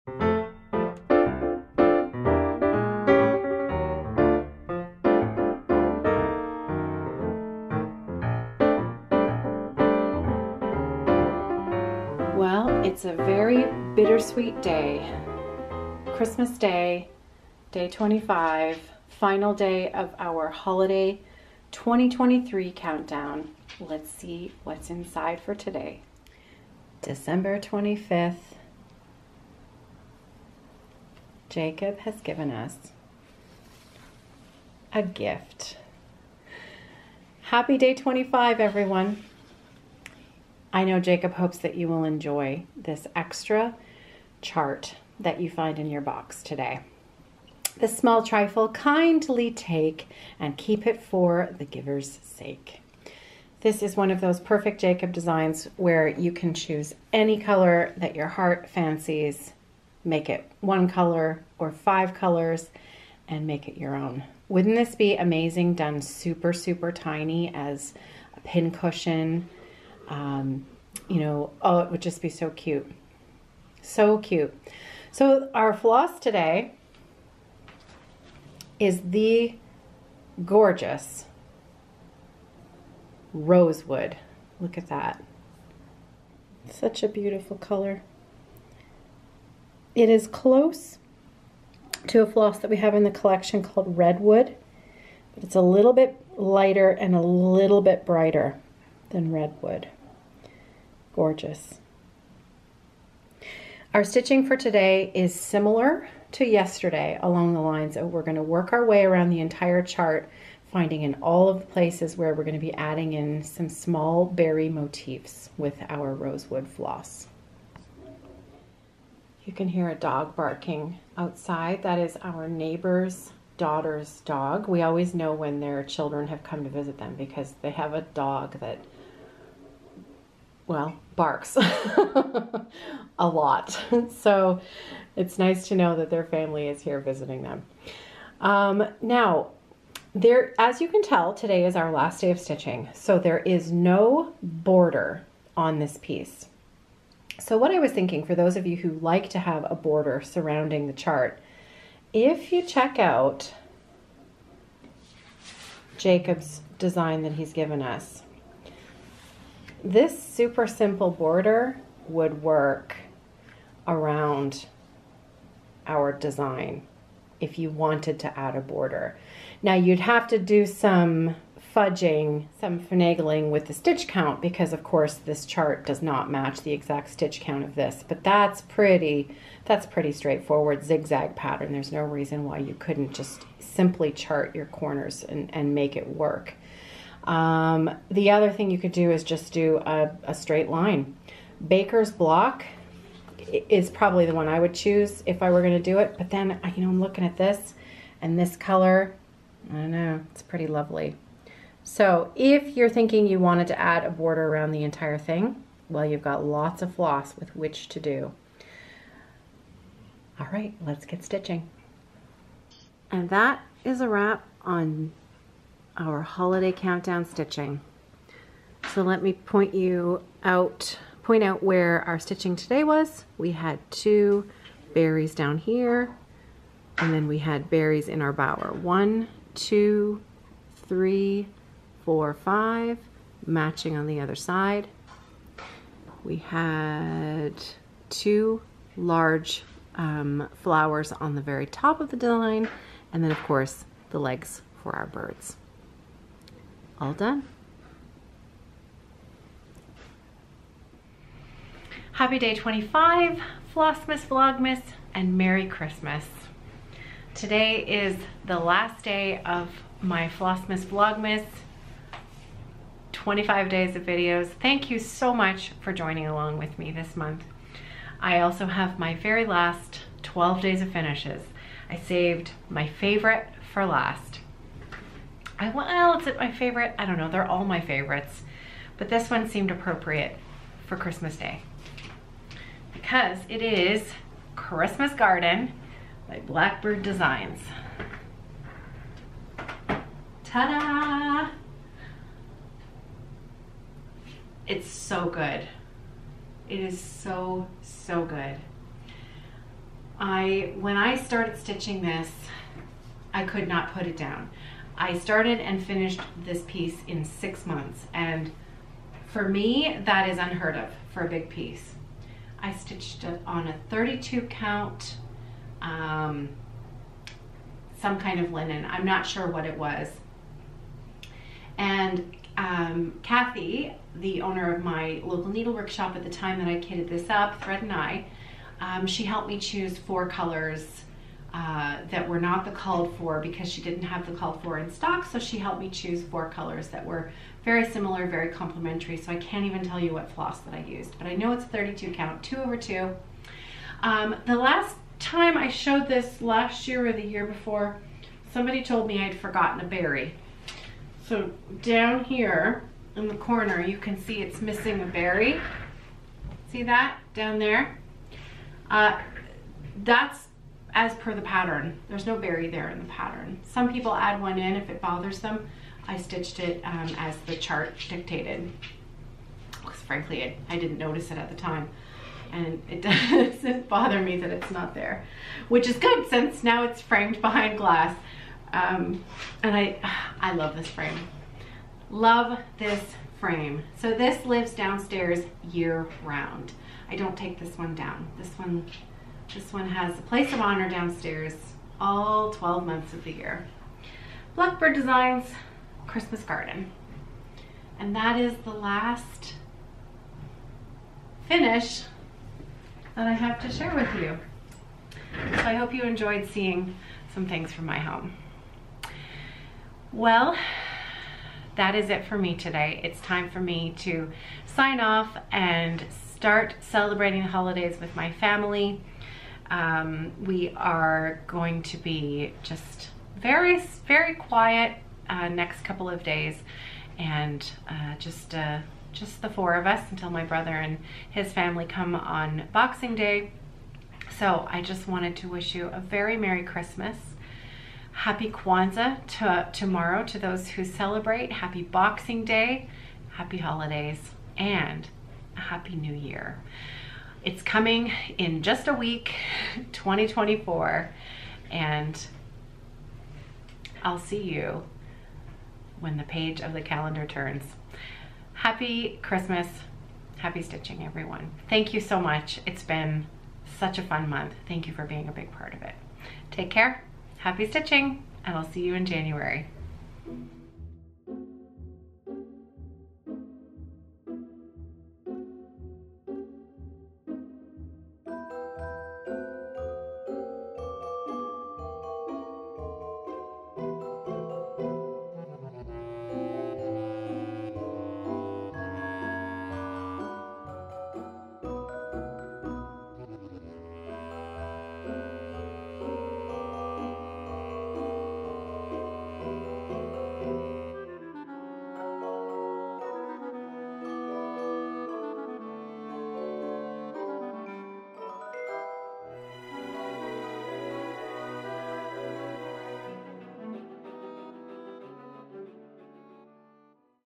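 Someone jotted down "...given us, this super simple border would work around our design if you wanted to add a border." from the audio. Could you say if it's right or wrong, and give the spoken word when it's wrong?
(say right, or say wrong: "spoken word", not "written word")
right.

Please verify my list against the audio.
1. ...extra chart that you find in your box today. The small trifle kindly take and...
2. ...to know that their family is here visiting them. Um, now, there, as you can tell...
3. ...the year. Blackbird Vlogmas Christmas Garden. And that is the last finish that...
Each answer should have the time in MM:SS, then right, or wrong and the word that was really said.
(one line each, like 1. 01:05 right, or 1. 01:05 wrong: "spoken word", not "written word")
1. 00:43 right
2. 02:15 right
3. 06:33 wrong: "Designs", not "Vlogmas".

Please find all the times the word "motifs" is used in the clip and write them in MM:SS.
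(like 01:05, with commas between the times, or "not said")
01:54.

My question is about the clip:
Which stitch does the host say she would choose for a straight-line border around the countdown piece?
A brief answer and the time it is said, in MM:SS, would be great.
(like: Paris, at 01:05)
Baker's block, at 03:11.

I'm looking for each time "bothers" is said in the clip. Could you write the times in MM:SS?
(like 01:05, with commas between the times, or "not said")
06:05, 06:13.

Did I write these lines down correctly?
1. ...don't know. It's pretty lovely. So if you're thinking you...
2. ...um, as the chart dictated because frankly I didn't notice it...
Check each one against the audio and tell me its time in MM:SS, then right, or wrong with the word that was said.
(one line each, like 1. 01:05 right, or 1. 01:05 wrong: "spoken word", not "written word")
1. 03:19 right
2. 06:06 right.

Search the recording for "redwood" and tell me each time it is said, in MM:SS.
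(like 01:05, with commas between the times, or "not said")
01:33, 01:39.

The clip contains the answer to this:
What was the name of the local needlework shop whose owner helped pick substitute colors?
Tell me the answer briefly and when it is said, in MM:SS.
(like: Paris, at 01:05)
Thread and I, at 05:27.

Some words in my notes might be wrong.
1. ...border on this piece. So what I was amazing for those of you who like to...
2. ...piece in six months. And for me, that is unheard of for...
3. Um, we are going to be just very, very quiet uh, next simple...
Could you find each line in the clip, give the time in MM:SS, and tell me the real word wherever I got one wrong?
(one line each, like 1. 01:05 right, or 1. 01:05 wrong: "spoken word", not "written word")
1. 02:24 wrong: "thinking", not "amazing"
2. 05:06 right
3. 06:59 wrong: "couple", not "simple".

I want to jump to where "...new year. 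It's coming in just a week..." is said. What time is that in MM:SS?
07:25.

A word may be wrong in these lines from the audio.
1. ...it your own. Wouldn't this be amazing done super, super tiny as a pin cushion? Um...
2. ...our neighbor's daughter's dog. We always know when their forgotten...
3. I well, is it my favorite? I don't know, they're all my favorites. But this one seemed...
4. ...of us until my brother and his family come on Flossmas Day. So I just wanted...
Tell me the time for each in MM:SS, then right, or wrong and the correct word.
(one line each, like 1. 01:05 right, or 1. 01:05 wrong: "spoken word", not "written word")
1. 01:03 right
2. 02:02 wrong: "children", not "forgotten"
3. 04:35 right
4. 07:09 wrong: "Boxing", not "Flossmas".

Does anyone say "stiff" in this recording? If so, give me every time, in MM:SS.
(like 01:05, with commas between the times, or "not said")
not said.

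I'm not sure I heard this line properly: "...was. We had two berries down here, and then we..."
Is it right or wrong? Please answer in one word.
right.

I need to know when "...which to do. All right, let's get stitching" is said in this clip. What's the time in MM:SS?
03:27.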